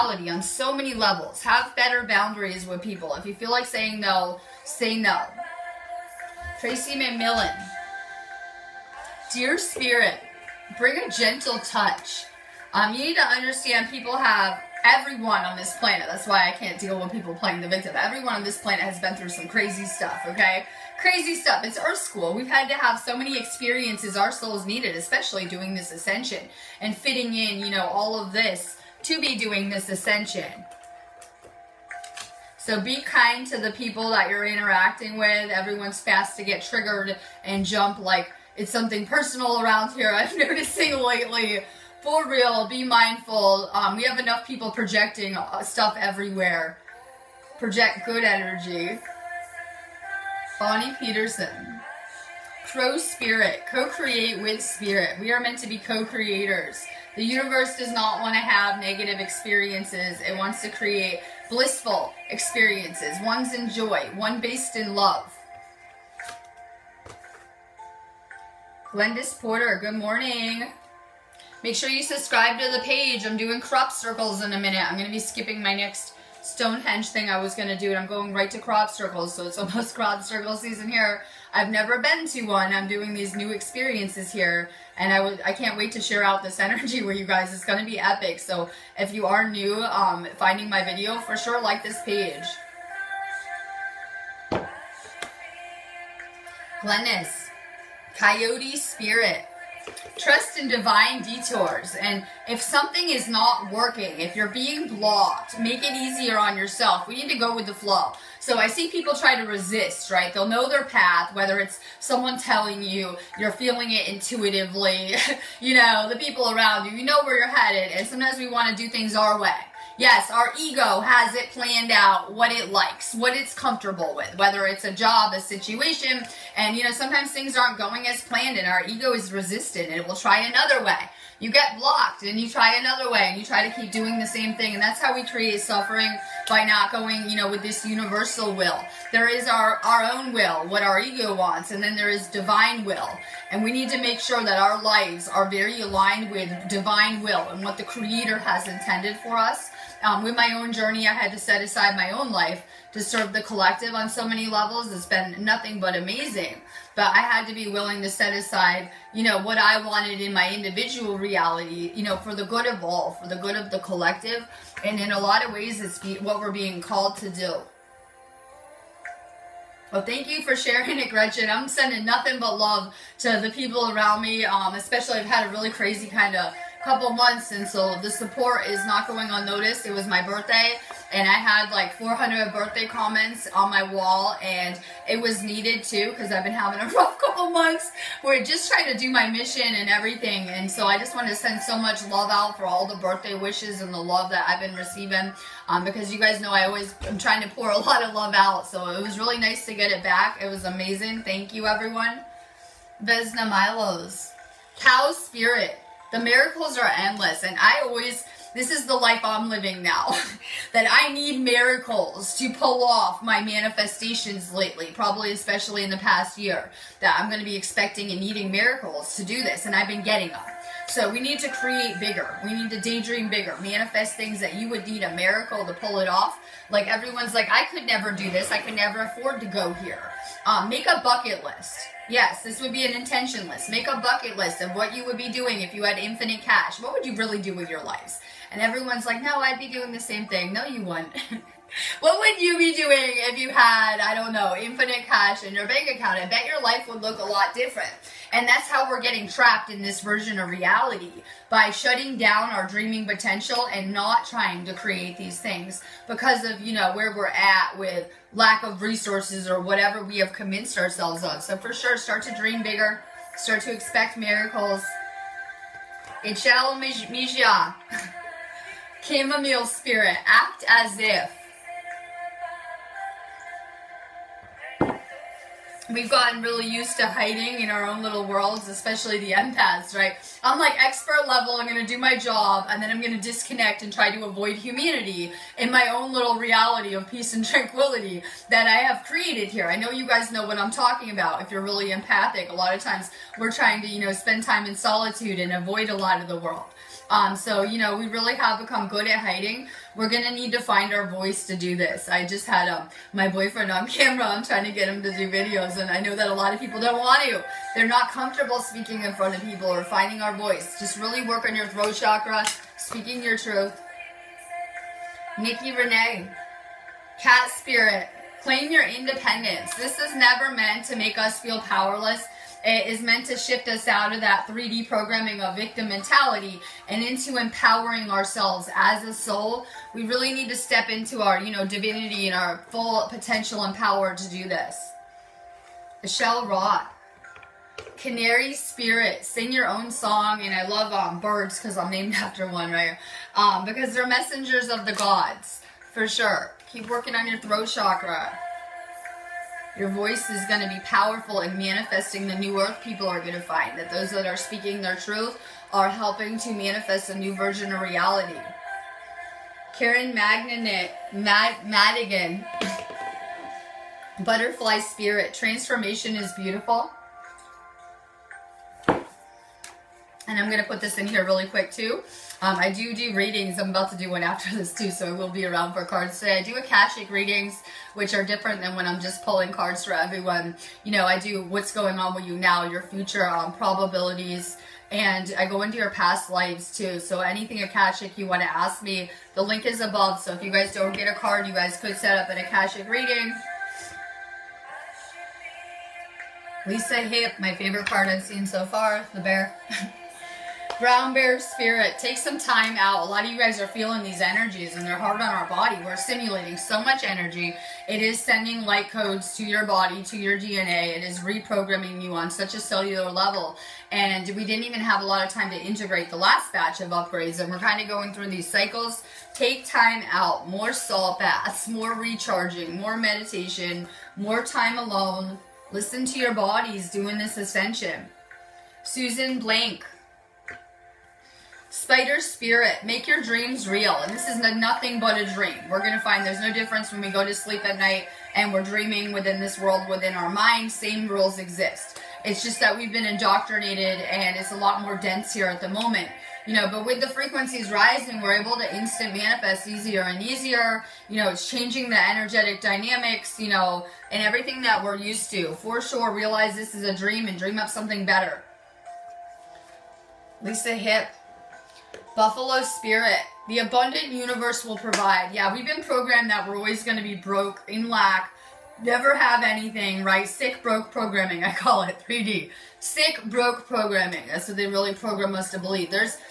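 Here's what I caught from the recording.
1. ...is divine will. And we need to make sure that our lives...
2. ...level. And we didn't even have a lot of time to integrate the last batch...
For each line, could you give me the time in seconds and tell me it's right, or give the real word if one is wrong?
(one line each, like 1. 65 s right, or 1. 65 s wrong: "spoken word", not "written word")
1. 142 s right
2. 413 s right.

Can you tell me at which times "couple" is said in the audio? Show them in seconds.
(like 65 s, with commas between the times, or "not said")
176 s, 187 s.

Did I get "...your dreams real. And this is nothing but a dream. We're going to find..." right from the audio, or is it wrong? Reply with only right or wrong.
right.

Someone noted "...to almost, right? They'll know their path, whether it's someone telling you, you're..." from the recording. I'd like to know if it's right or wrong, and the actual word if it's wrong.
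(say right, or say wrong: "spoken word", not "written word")
wrong: "resist", not "almost".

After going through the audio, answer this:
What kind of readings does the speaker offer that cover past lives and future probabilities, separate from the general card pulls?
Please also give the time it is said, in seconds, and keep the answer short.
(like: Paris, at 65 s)
Akashic readings, at 376 s.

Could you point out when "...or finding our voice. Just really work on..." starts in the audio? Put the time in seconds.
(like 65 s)
309 s.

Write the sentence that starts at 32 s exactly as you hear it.
So be kind to the people that you're interacting with.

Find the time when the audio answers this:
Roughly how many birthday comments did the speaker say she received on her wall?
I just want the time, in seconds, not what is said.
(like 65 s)
181 s.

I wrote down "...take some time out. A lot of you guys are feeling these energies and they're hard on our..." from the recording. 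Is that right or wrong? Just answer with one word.
right.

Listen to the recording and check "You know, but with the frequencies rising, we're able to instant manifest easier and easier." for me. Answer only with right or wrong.
right.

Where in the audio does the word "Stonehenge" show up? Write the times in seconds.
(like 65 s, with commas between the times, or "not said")
76 s.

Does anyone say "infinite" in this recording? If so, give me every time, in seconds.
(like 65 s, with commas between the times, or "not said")
235 s, 244 s.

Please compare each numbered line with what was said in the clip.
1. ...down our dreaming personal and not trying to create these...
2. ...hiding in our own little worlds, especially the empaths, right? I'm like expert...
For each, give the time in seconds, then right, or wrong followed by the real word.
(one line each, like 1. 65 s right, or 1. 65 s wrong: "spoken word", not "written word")
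1. 252 s wrong: "potential", not "personal"
2. 277 s right.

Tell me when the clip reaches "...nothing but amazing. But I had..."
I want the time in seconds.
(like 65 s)
155 s.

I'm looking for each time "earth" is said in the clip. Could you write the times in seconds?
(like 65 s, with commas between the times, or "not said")
21 s, 352 s.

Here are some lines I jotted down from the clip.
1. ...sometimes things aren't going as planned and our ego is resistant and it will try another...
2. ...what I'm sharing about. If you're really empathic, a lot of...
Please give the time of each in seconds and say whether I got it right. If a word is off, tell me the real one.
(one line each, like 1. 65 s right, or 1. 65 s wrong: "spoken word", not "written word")
1. 126 s right
2. 290 s wrong: "talking", not "sharing".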